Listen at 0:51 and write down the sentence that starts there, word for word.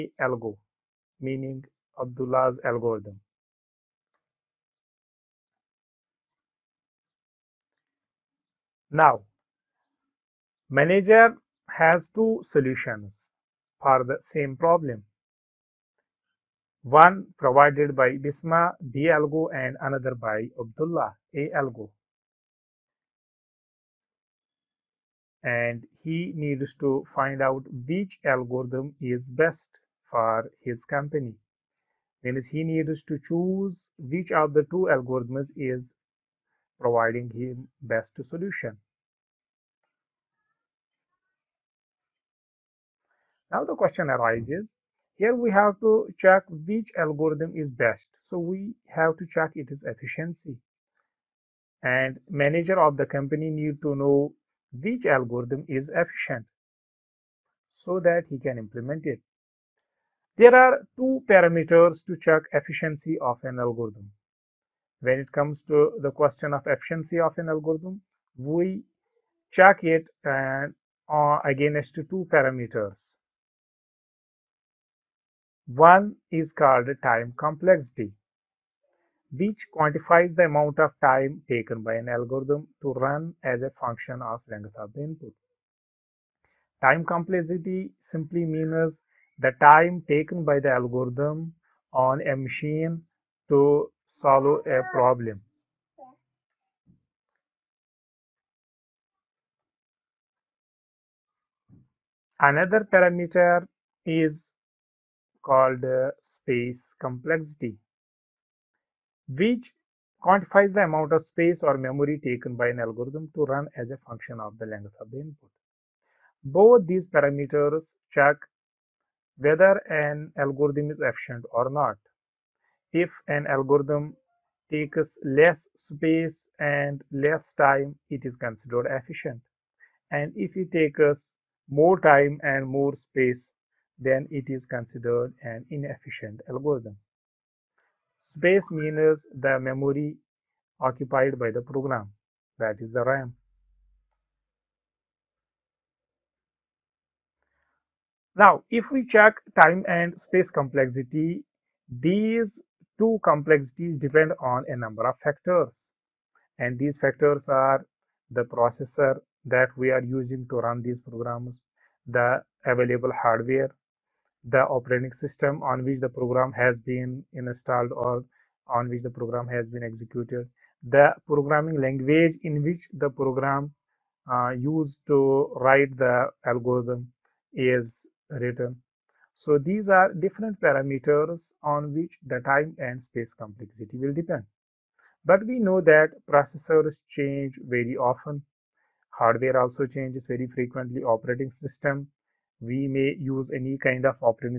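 And manager of the company need to know which algorithm is efficient so that he can implement it.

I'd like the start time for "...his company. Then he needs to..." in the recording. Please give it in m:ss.
0:30.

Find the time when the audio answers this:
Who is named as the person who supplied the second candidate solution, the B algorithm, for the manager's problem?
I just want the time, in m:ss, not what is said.
0:18.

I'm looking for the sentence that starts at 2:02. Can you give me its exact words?
If an algorithm takes less space and less time, it is considered efficient.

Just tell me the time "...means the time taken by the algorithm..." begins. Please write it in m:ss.
1:28.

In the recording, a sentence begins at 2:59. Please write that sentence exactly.
So these are different parameters on which the time and space complexity will depend.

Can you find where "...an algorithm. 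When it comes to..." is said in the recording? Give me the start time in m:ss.
1:03.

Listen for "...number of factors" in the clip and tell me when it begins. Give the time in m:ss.
2:34.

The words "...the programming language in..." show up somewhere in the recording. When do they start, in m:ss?
2:50.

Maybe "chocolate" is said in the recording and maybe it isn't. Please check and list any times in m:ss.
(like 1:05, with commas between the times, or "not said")
not said.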